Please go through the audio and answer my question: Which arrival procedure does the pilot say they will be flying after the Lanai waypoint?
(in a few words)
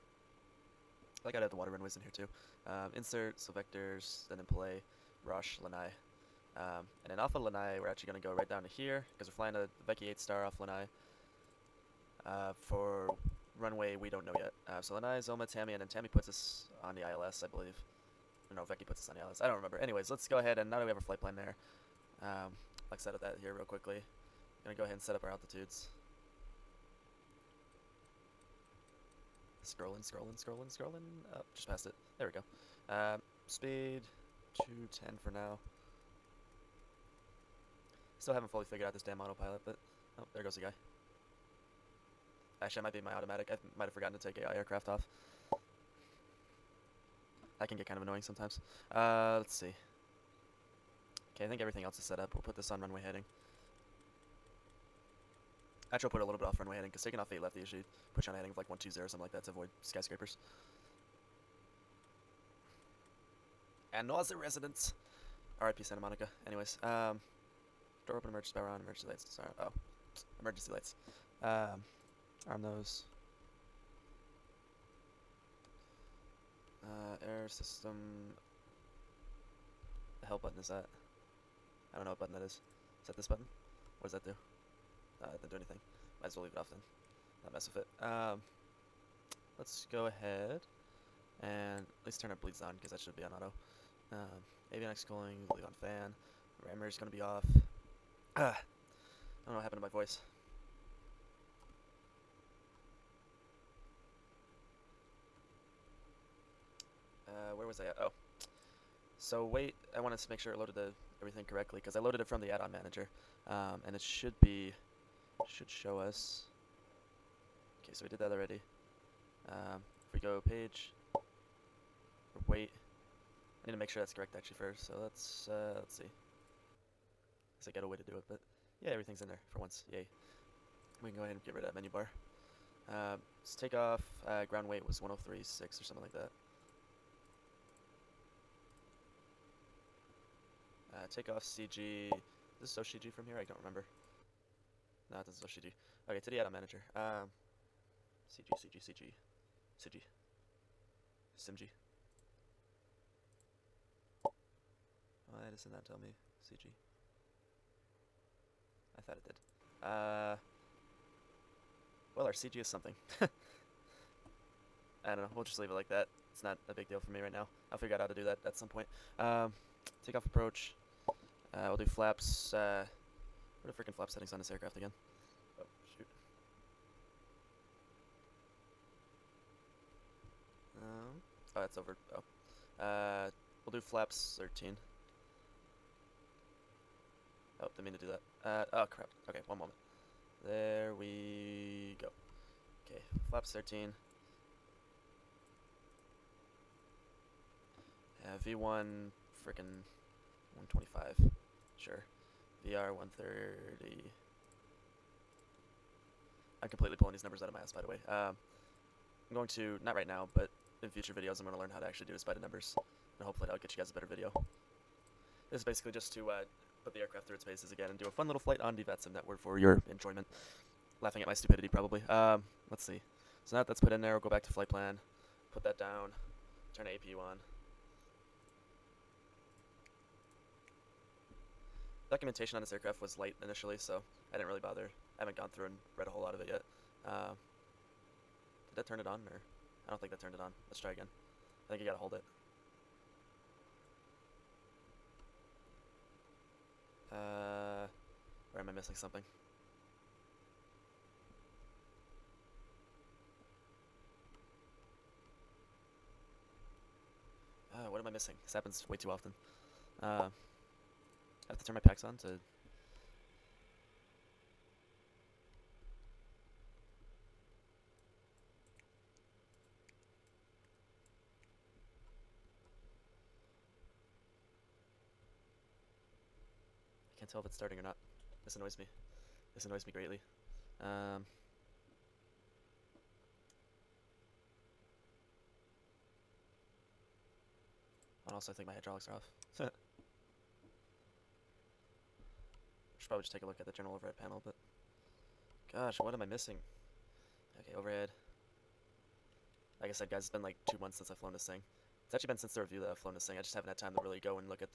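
Vecchi 8 star.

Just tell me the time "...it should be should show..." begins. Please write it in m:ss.
1:53.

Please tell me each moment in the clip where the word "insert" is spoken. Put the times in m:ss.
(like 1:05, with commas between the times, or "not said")
0:02.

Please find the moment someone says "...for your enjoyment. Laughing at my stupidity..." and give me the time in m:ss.
3:39.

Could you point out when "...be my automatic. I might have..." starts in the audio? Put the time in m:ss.
0:42.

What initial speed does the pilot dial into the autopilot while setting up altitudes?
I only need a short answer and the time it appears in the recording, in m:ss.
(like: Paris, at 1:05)
210, at 0:34.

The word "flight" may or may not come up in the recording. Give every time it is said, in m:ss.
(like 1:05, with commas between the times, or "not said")
0:21, 3:38, 3:44.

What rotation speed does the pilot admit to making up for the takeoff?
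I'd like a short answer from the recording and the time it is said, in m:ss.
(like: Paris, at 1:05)
130, at 3:22.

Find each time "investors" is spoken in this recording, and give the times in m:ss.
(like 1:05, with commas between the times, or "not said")
not said.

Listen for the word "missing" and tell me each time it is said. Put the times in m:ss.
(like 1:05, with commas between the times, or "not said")
4:08, 4:18, 4:56.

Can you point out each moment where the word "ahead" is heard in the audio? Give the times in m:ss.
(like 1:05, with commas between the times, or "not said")
0:20, 0:24, 1:30, 2:11.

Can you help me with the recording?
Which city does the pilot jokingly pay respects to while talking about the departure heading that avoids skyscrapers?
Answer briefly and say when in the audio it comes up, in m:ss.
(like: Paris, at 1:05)
Santa Monica, at 1:05.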